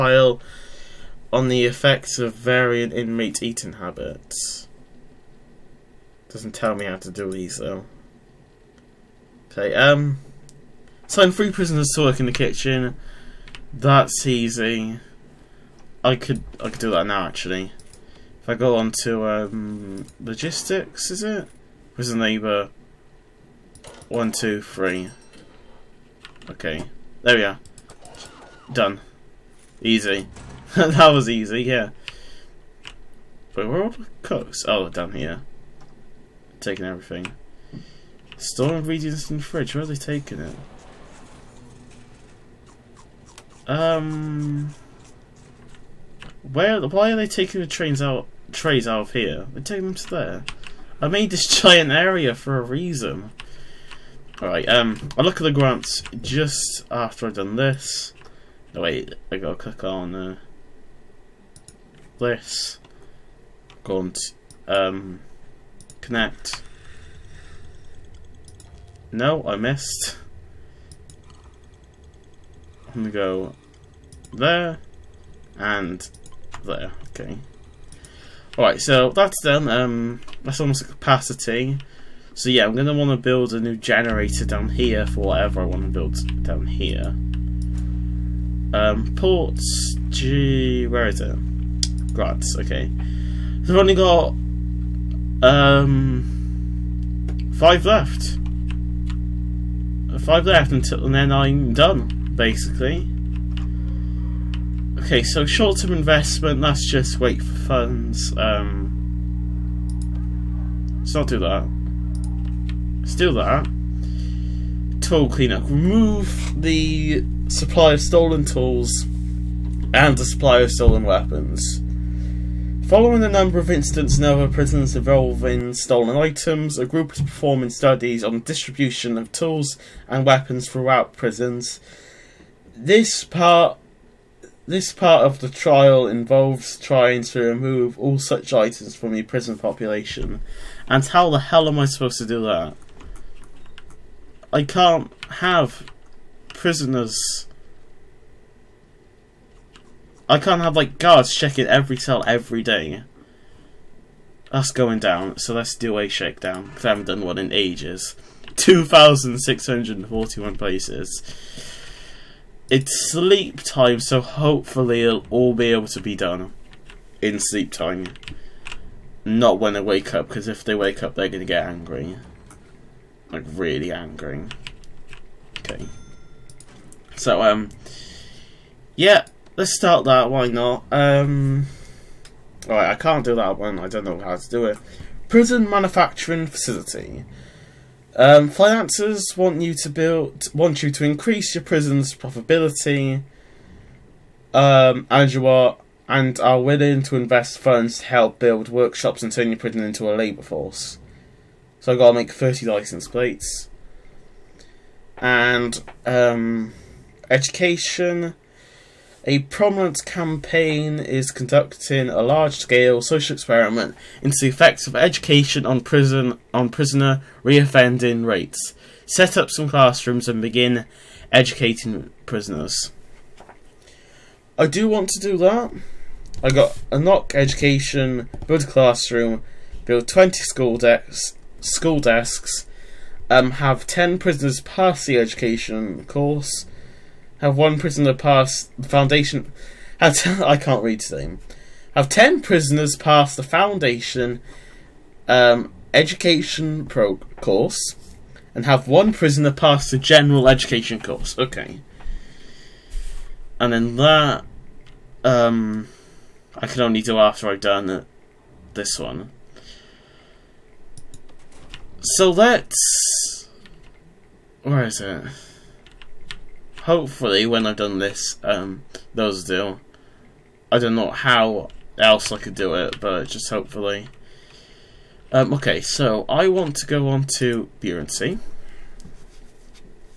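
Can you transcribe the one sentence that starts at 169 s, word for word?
Not when they wake up, because if they wake up, they're going to get angry.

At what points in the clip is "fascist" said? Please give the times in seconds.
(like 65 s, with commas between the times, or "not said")
not said.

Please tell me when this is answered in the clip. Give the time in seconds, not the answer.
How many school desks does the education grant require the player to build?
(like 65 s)
230 s.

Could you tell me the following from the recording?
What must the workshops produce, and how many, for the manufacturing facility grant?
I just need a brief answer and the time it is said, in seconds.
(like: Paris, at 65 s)
30 license plates, at 202 s.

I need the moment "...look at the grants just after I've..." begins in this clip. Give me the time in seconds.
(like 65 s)
55 s.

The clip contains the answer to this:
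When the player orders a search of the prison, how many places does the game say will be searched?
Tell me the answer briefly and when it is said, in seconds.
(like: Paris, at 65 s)
2,641, at 158 s.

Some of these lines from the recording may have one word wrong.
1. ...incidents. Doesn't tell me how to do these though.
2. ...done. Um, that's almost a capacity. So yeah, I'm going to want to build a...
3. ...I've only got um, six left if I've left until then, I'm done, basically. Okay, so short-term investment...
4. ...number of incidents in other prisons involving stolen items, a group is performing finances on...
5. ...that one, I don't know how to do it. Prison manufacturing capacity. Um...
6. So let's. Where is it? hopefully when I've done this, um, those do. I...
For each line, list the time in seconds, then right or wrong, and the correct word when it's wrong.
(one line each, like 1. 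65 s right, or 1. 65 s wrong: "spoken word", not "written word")
1. 3 s wrong: "habits", not "incidents"
2. 79 s right
3. 93 s wrong: "five", not "six"
4. 123 s wrong: "studies", not "finances"
5. 183 s wrong: "facility", not "capacity"
6. 262 s right.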